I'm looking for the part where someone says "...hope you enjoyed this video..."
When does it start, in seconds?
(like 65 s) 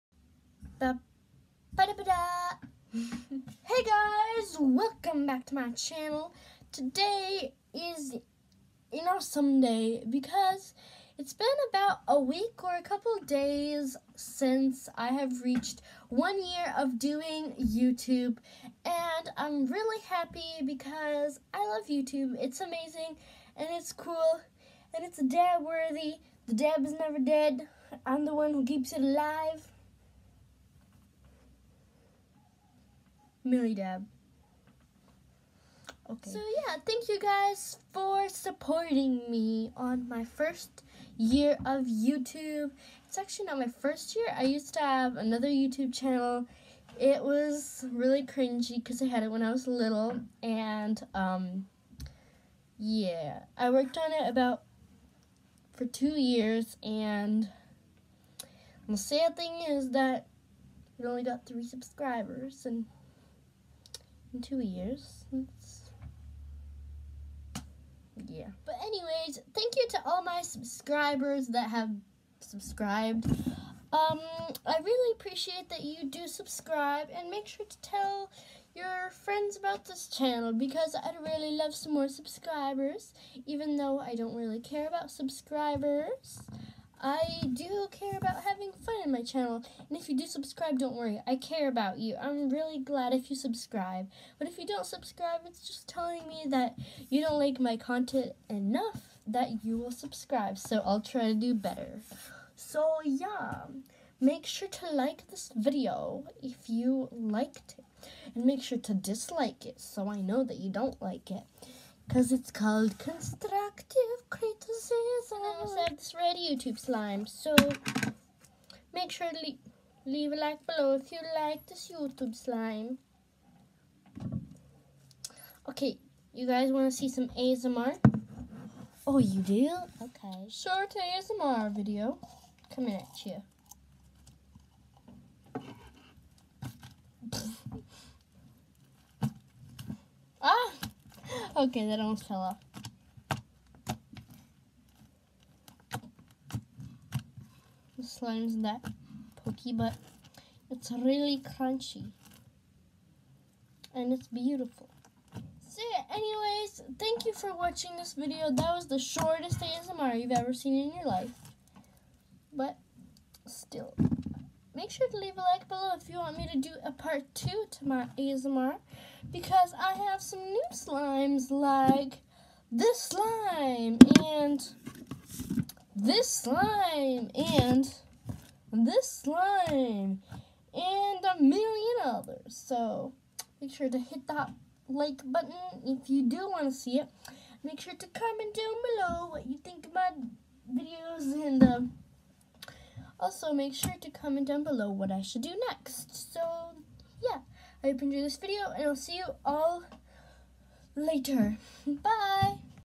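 197 s.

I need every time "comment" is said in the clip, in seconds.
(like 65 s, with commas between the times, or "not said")
188 s, 194 s.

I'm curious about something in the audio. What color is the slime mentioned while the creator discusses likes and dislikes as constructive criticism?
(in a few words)
Red.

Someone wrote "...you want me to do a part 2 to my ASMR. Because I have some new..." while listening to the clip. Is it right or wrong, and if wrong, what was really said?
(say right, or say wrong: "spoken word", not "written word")
right.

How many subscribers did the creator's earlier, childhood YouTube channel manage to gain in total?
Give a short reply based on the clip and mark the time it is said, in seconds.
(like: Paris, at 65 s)
3, at 61 s.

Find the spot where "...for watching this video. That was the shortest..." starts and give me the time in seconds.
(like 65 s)
157 s.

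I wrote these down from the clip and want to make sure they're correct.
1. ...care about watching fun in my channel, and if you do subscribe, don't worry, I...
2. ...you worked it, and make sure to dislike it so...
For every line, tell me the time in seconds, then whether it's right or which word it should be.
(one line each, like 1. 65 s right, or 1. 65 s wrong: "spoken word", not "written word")
1. 87 s wrong: "having", not "watching"
2. 106 s wrong: "liked", not "worked".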